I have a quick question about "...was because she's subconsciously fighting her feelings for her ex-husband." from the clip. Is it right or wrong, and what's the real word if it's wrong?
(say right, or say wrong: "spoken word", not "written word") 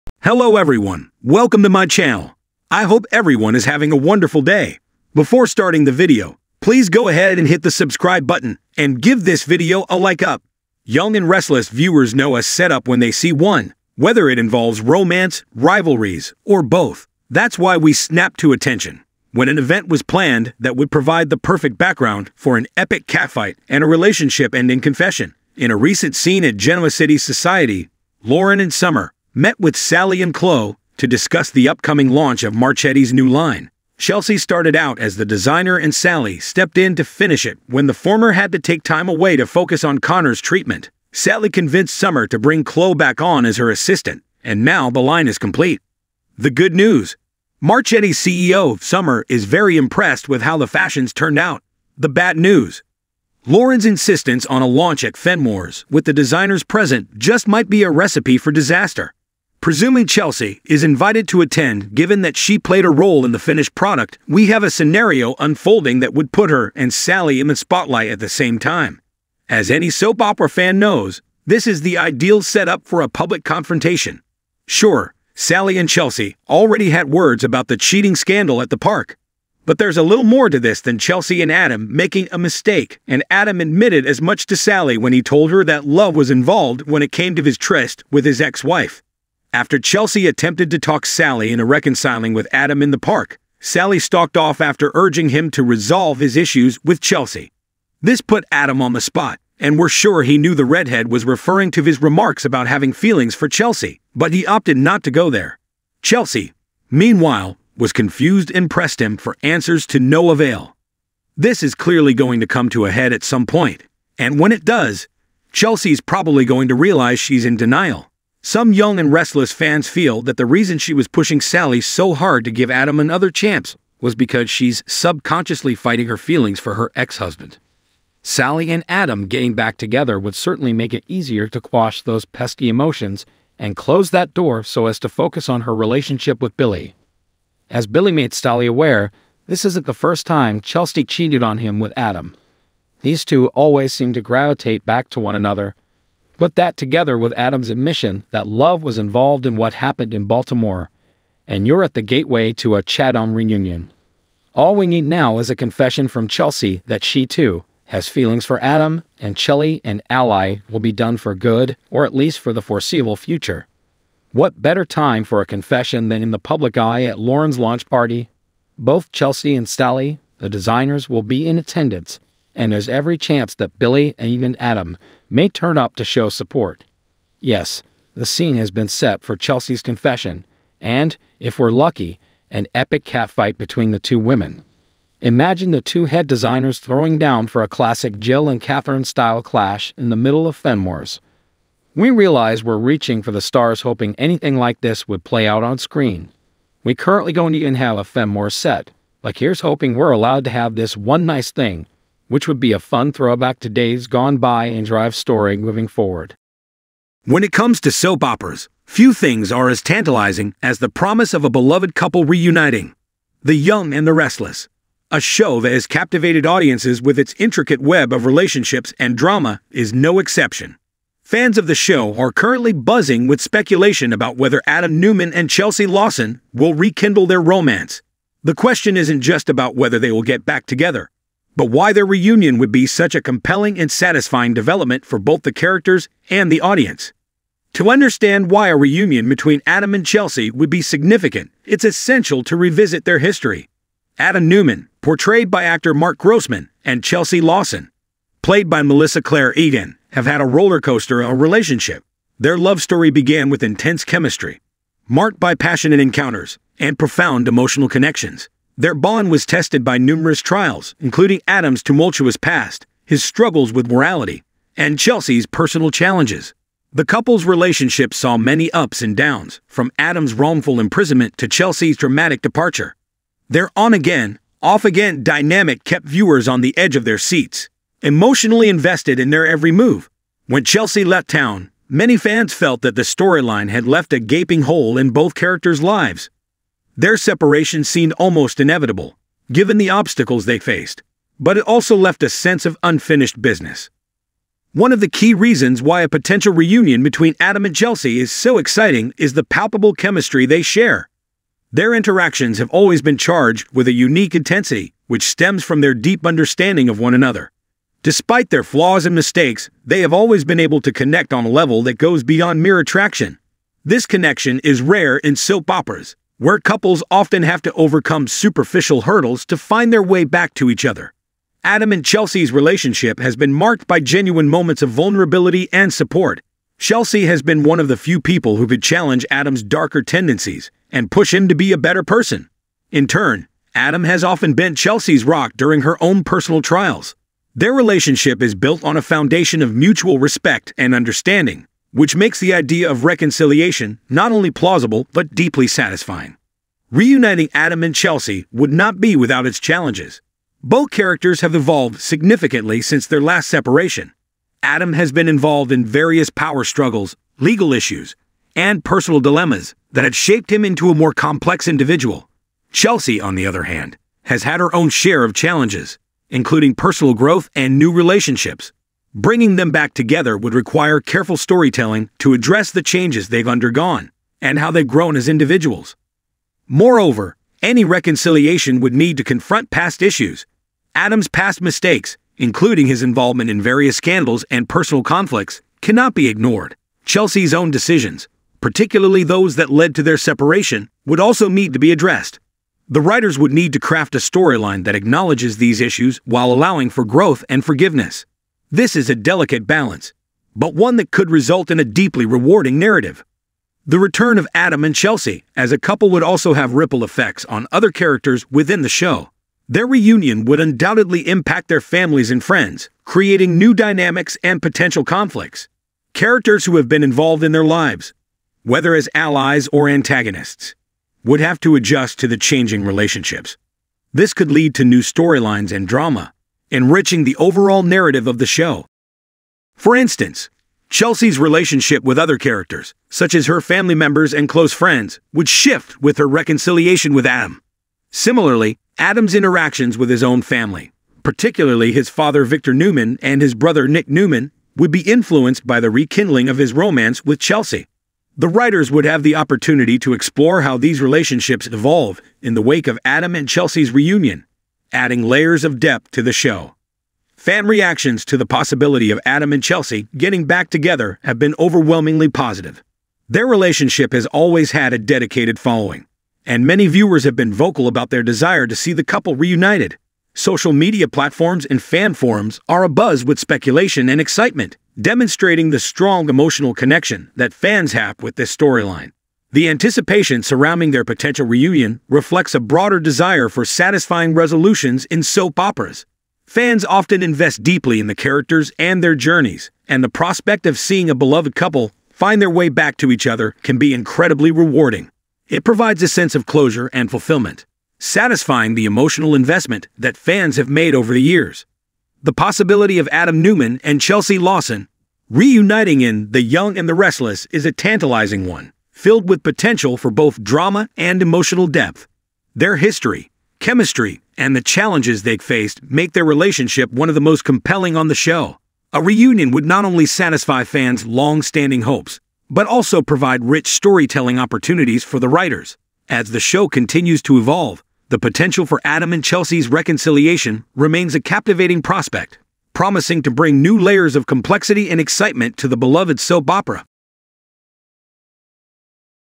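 right.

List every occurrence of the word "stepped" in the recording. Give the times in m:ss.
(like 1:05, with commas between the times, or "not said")
0:36.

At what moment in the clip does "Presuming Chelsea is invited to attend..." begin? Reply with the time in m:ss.
0:59.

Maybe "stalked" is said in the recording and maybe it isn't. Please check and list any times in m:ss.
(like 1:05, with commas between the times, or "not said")
1:33.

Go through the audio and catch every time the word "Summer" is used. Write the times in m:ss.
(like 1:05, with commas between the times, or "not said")
0:28, 0:41, 0:48.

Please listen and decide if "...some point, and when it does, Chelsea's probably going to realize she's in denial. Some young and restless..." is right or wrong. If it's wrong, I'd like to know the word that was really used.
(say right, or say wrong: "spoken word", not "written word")
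right.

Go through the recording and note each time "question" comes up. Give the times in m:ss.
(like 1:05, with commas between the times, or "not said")
3:48.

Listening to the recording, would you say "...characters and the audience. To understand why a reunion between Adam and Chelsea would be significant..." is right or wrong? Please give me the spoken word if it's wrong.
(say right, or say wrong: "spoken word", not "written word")
right.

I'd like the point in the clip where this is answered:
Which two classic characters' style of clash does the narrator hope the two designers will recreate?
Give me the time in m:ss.
3:08.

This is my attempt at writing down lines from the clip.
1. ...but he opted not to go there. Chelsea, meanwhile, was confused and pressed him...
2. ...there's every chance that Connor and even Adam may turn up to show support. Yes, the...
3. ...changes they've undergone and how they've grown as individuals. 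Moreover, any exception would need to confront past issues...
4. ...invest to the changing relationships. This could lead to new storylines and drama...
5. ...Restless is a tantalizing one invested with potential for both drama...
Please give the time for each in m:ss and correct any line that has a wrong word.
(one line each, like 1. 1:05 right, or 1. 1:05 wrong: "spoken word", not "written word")
1. 1:44 right
2. 2:52 wrong: "Billy", not "Connor"
3. 6:12 wrong: "reconciliation", not "exception"
4. 7:01 wrong: "adjust", not "invest"
5. 8:26 wrong: "filled", not "invested".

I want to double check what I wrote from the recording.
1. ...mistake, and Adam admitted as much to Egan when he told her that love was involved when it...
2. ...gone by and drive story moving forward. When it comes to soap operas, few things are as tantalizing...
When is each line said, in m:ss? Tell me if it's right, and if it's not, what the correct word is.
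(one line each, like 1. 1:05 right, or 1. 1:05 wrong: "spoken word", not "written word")
1. 1:22 wrong: "Sally", not "Egan"
2. 3:24 right.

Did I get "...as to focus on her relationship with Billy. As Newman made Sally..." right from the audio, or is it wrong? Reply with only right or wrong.
wrong.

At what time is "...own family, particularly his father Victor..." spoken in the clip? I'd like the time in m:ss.
7:20.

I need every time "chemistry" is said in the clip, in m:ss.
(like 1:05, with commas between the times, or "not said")
4:14, 4:59, 8:33.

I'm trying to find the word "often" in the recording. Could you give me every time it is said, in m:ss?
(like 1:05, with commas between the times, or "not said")
5:17, 5:34, 8:06.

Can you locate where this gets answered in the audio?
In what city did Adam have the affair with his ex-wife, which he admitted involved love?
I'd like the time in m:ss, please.
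2:30.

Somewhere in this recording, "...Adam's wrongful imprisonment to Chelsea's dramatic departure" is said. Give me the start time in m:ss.
4:29.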